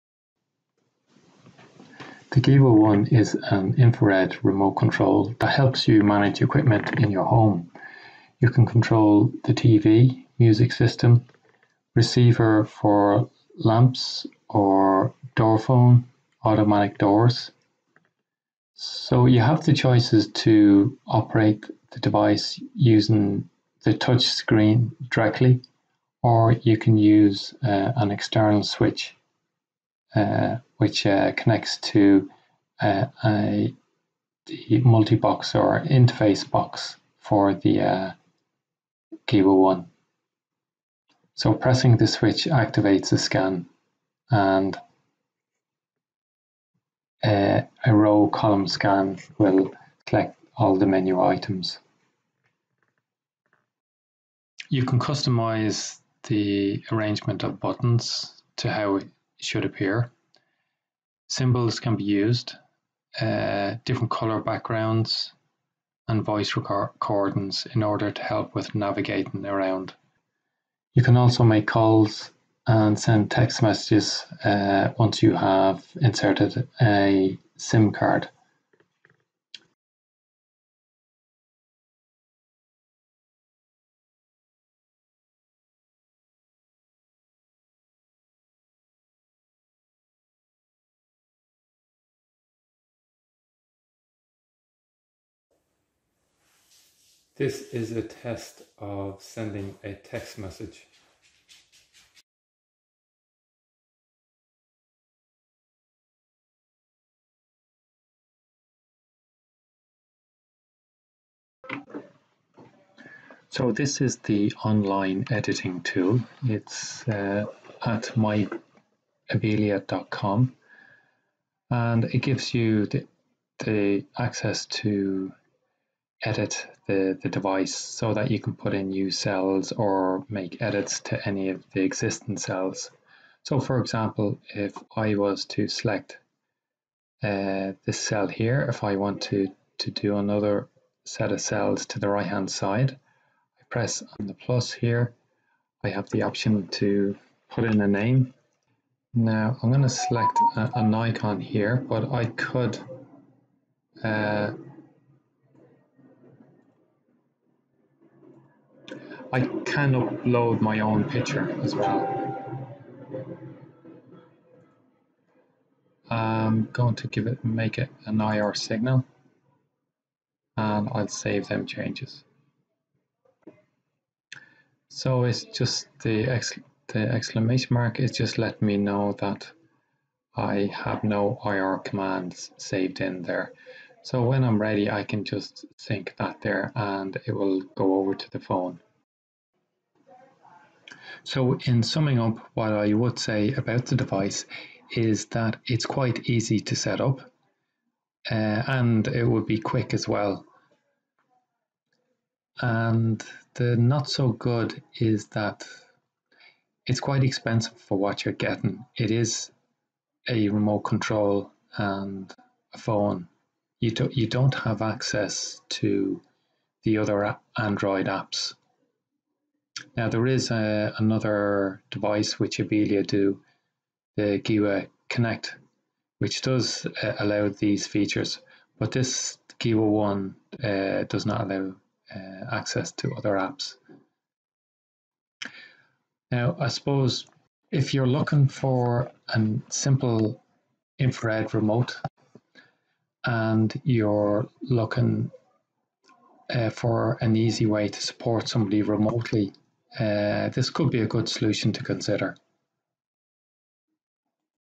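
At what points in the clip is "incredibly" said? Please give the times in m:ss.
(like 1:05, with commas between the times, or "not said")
not said.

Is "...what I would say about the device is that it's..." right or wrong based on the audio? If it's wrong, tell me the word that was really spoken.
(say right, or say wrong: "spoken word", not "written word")
right.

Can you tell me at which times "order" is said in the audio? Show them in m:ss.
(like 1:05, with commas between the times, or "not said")
1:07.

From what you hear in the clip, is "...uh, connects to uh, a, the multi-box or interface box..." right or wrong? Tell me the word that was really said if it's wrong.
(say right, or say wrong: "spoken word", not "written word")
right.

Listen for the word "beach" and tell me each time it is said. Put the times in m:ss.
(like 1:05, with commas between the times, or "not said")
not said.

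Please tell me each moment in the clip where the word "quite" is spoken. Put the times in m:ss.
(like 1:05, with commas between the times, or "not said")
3:15, 3:27.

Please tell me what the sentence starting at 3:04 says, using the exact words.
So when I'm ready, I can just sync that there and it will go over to the phone.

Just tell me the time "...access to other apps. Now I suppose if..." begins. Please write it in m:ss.
3:52.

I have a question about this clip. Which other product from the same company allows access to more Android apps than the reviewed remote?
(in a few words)
Gewa Connect.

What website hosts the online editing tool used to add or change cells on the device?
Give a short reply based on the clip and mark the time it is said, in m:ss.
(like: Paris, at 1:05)
myabilia.com, at 1:58.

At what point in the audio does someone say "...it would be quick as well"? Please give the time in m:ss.
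3:19.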